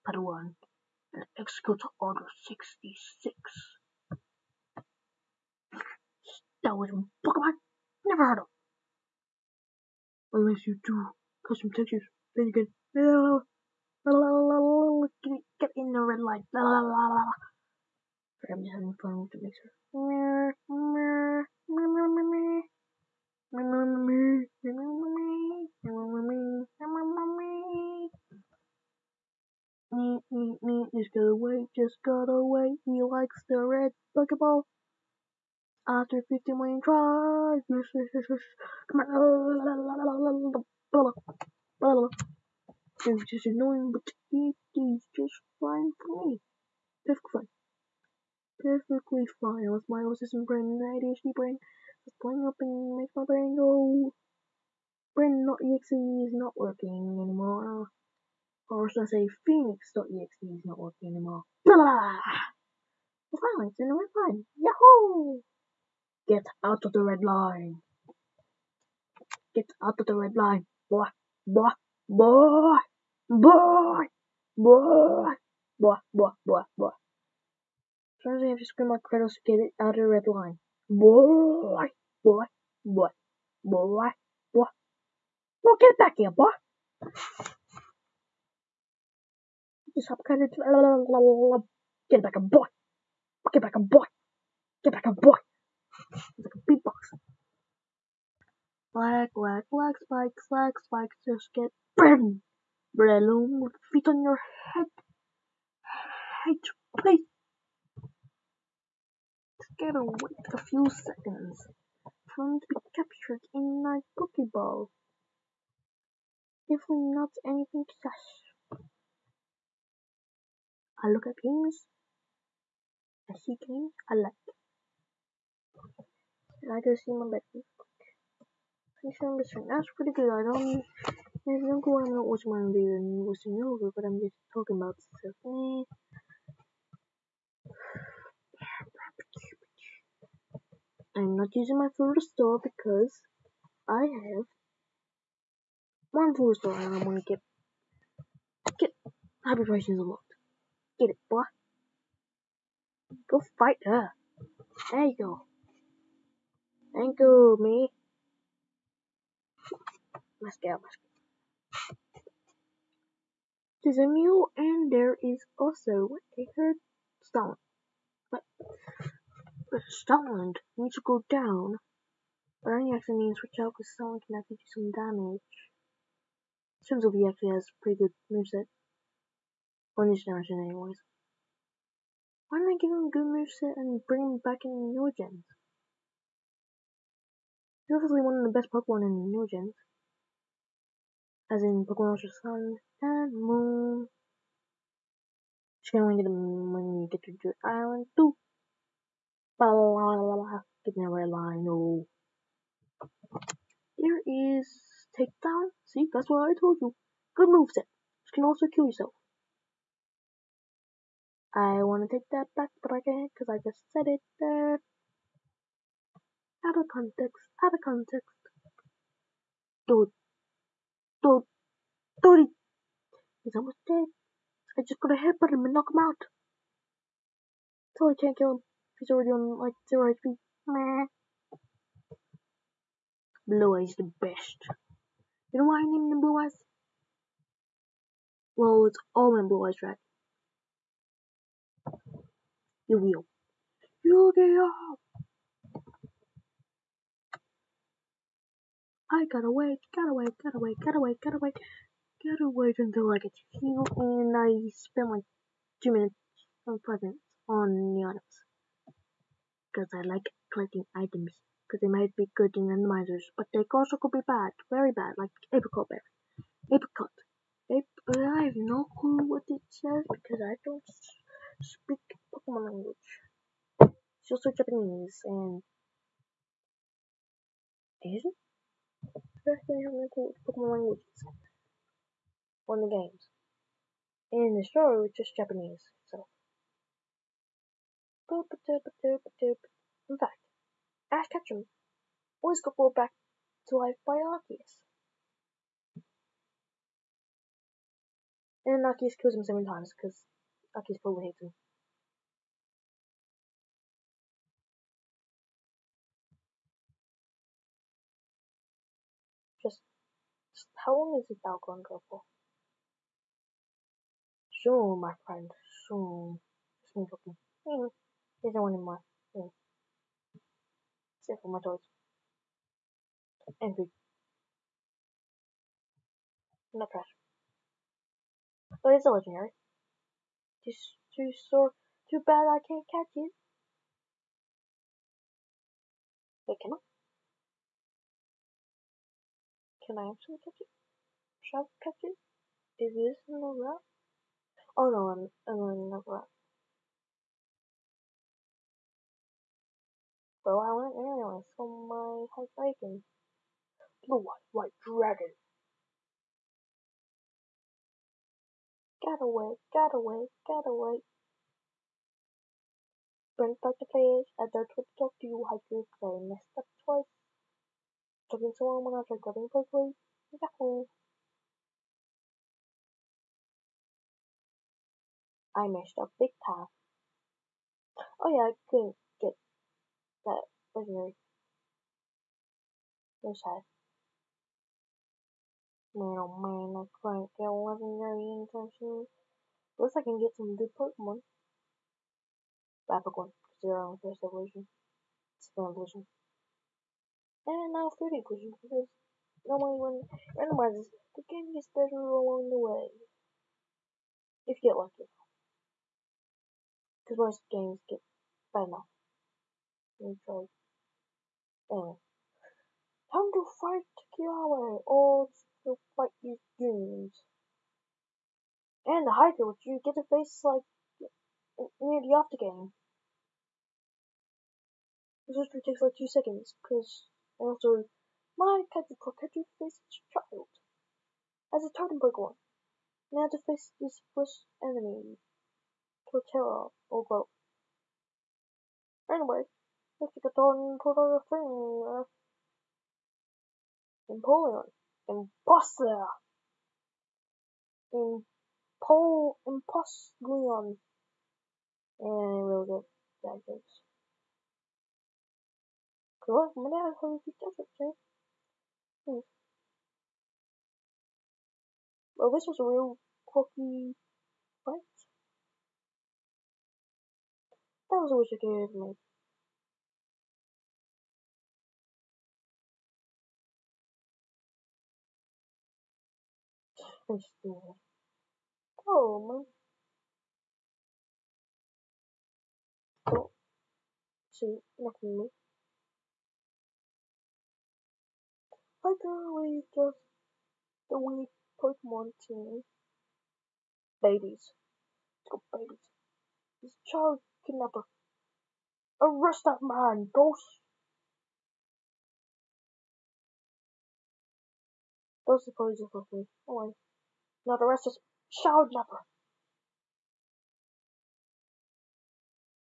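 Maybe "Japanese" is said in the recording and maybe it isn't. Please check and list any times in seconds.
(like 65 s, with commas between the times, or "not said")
274 s, 285 s.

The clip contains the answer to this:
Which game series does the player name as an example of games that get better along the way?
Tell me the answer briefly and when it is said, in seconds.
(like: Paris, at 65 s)
Metroid, at 410 s.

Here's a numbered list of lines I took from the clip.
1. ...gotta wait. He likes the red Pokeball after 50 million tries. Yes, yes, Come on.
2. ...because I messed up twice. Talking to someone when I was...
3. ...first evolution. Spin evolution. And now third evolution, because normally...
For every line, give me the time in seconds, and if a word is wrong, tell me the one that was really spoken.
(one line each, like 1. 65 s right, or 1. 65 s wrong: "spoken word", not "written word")
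1. 32 s right
2. 365 s right
3. 393 s right.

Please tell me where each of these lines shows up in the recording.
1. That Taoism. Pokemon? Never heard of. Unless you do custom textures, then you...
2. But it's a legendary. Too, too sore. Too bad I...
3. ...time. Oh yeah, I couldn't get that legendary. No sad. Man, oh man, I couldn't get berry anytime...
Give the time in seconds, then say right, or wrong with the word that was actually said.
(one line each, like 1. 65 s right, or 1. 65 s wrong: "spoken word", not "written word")
1. 6 s right
2. 328 s right
3. 376 s wrong: "legendary", not "berry".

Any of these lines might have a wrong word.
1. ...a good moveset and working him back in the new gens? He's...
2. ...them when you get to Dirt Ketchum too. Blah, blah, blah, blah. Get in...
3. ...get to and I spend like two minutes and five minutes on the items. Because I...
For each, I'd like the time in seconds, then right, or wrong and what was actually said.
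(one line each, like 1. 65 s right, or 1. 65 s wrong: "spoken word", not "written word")
1. 183 s wrong: "bring", not "working"
2. 196 s wrong: "Island", not "Ketchum"
3. 253 s right.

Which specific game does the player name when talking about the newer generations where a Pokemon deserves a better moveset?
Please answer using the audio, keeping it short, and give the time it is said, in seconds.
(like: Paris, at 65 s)
Pokemon Ultra Sun and Moon, at 191 s.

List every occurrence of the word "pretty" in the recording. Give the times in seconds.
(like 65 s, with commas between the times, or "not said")
129 s, 177 s.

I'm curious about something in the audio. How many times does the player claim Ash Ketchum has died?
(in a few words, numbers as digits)
7.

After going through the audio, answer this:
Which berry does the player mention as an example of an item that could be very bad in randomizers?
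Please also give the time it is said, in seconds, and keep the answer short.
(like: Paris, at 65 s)
Apricot berry, at 265 s.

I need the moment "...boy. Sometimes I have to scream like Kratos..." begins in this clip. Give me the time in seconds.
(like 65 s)
76 s.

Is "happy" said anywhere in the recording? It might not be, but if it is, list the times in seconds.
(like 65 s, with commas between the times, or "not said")
149 s.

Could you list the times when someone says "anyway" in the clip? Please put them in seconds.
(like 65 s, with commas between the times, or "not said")
180 s, 350 s, 411 s, 439 s.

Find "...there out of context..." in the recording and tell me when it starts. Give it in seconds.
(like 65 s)
214 s.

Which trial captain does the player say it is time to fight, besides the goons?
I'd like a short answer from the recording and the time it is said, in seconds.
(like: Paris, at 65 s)
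Kiawe, at 414 s.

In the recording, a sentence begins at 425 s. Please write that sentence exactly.
This just takes like two seconds, because, also, my face Kaiju faced child as a totem Pokemon.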